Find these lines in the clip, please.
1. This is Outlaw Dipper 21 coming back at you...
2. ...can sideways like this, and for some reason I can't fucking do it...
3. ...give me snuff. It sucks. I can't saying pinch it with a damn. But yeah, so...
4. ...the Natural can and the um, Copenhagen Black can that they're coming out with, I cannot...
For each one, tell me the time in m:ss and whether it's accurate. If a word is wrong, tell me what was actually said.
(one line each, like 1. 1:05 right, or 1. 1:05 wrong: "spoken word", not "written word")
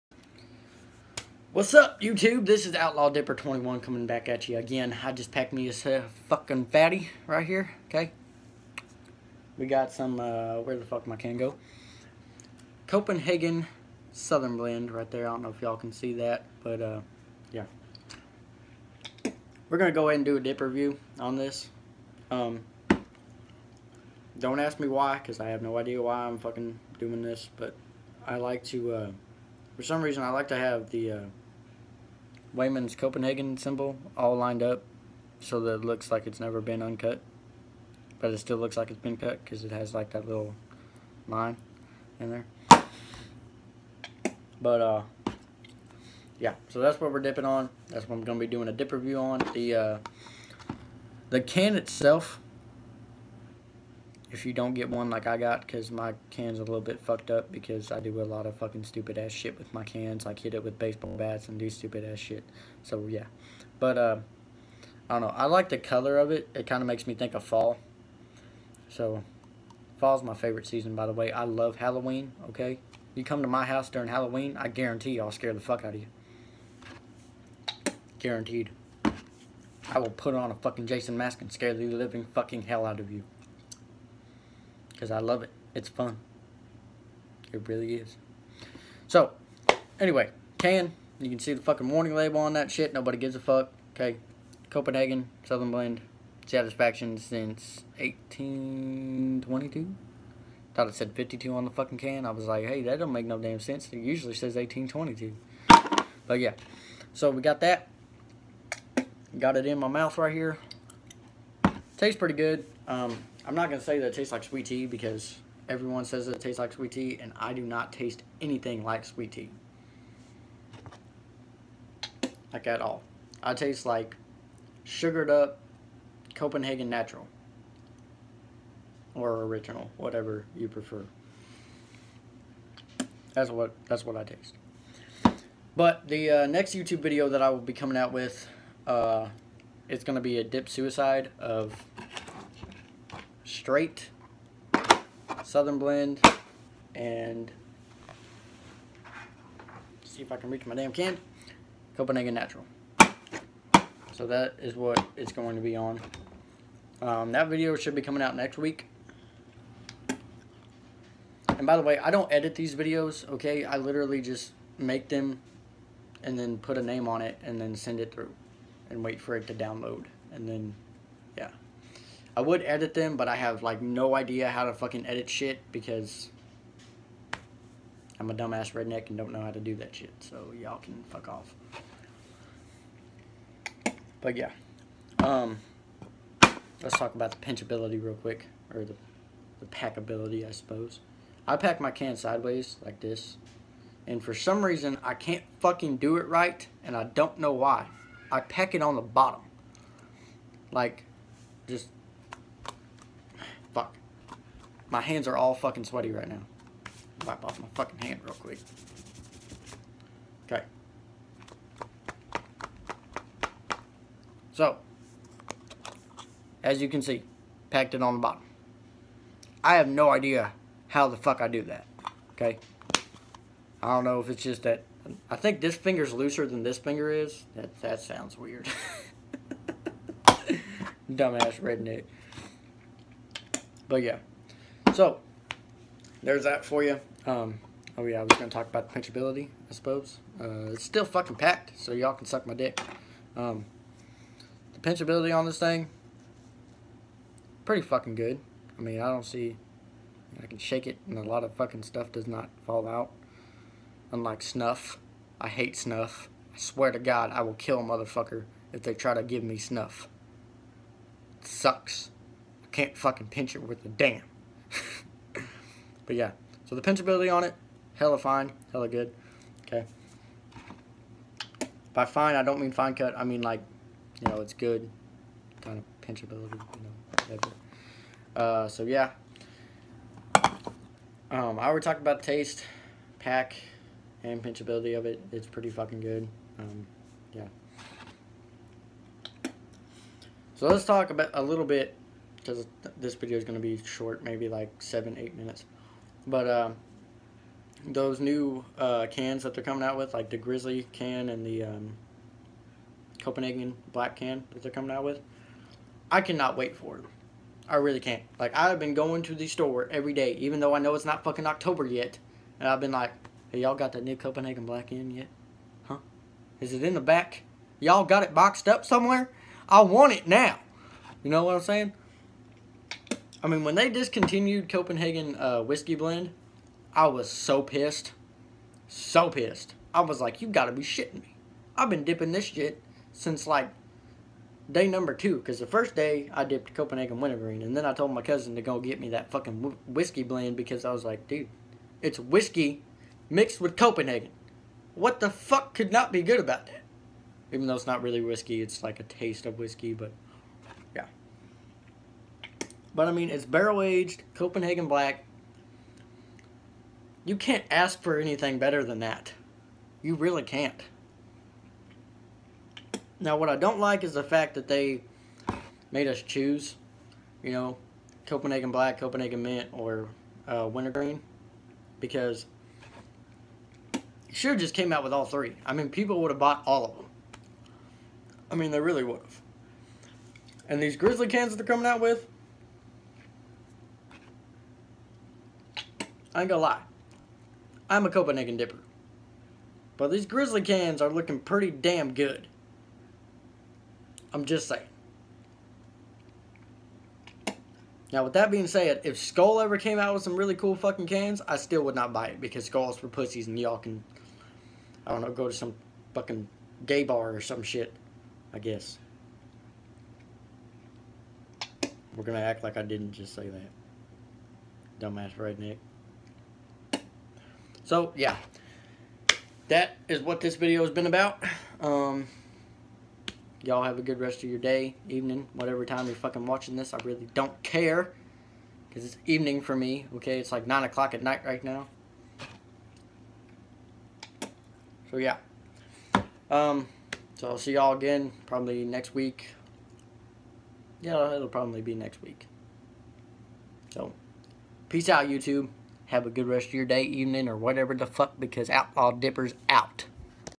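1. 0:02 right
2. 3:11 right
3. 4:19 wrong: "fucking", not "saying"
4. 5:00 wrong: "Grizzly", not "Natural".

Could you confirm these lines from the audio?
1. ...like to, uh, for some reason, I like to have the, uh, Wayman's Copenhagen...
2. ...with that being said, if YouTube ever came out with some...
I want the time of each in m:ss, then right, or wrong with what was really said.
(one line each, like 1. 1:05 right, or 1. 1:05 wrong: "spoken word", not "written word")
1. 0:28 right
2. 6:38 wrong: "Skoal", not "YouTube".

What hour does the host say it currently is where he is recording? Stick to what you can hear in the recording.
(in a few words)
9 o'clock.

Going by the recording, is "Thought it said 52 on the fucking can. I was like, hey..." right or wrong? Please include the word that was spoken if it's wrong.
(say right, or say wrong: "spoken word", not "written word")
right.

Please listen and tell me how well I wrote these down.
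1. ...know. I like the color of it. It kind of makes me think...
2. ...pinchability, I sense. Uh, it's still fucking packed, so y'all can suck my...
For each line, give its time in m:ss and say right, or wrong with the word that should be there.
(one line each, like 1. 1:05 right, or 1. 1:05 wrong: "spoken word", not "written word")
1. 1:05 right
2. 3:58 wrong: "suppose", not "sense".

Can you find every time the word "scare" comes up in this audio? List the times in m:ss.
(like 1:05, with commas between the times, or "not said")
1:15, 1:21.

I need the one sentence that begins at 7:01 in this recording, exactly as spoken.
Um, Y'all have a good rest of your day, evening, whatever time you're fucking watching this.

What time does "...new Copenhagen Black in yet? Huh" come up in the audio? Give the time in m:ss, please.
5:14.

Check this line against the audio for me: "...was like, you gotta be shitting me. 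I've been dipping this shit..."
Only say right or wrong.
right.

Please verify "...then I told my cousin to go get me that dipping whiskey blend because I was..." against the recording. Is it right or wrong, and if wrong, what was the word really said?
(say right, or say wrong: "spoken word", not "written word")
wrong: "fucking", not "dipping".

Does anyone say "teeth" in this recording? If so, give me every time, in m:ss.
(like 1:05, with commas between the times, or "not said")
not said.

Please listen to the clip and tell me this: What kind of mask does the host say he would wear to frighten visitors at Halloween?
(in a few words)
Jason mask.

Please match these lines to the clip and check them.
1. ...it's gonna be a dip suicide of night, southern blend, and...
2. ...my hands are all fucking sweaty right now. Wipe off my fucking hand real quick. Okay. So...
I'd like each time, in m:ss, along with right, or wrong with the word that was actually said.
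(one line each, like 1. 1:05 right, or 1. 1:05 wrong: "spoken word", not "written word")
1. 2:19 wrong: "straight", not "night"
2. 3:24 right.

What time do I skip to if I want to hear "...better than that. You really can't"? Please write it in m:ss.
5:58.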